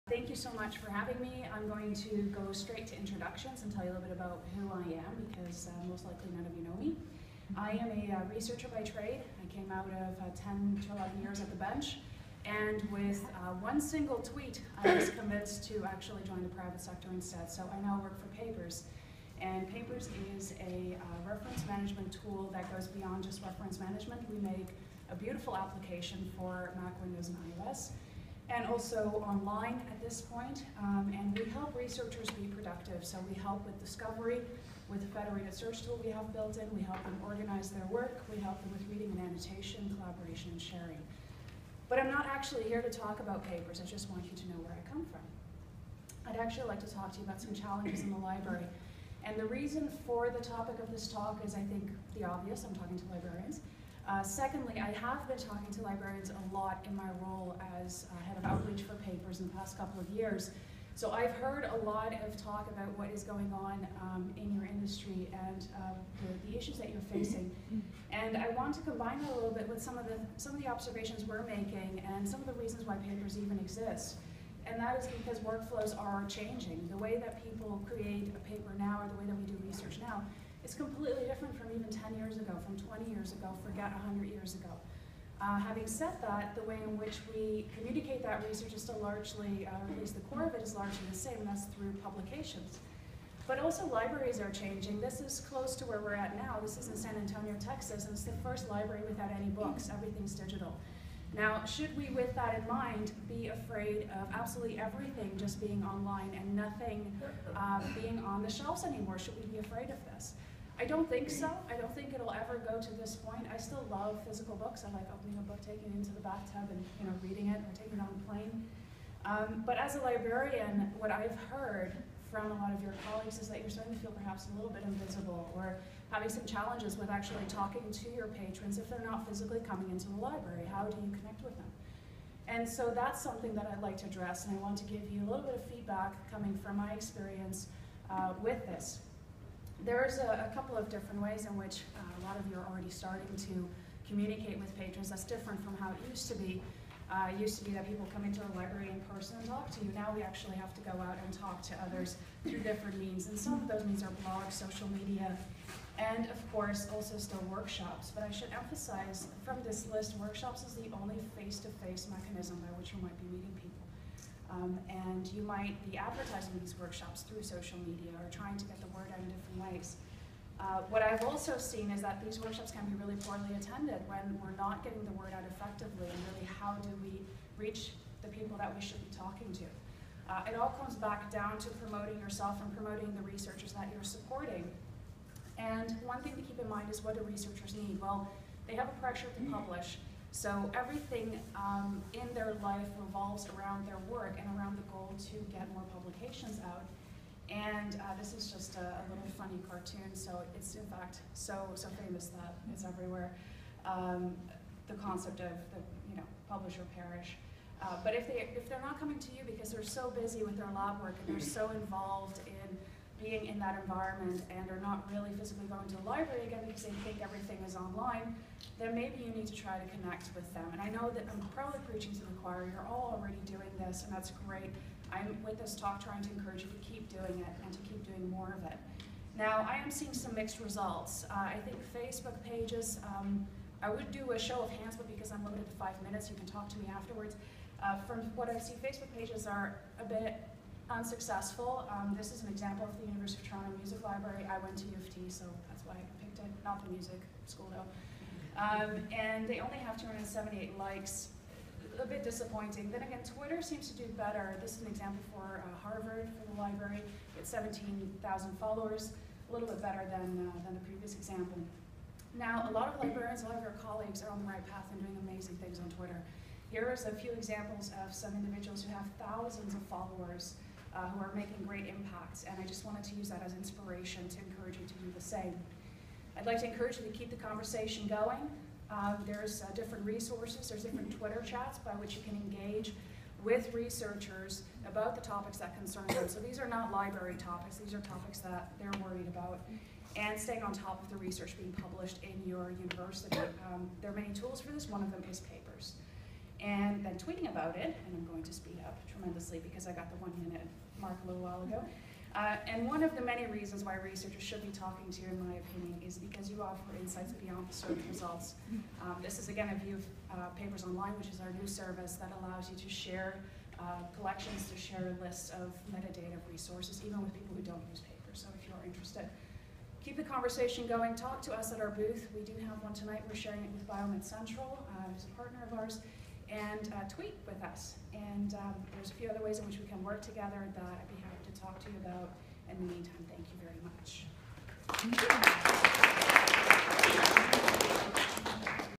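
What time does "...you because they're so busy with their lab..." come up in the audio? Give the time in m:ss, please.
3:29.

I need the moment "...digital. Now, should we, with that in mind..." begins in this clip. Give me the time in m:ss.
1:40.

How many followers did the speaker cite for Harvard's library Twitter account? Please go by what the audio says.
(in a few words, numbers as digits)
17,000.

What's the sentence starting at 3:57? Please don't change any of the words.
Uh, from what I see, Facebook pages are a bit unsuccessful.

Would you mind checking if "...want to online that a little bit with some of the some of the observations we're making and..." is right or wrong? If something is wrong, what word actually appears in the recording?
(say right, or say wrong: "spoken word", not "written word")
wrong: "combine", not "online".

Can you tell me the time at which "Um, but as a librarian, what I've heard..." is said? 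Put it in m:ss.
1:59.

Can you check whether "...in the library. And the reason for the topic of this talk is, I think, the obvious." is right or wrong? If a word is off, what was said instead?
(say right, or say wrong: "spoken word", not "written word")
right.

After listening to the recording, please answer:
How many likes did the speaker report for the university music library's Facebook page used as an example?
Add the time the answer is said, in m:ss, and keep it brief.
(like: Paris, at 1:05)
278, at 4:09.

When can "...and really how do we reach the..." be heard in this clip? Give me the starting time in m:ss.
2:56.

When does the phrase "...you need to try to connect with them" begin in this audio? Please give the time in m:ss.
3:39.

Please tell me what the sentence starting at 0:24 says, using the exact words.
We make a beautiful application for Mac, Windows, and iOS and also online at this point.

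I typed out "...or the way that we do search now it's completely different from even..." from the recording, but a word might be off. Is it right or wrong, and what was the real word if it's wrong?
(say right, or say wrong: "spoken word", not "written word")
wrong: "research", not "search".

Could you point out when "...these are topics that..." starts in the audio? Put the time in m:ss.
4:47.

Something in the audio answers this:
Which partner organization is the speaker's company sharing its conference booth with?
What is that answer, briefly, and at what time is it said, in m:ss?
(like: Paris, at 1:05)
Biomed Central, at 5:23.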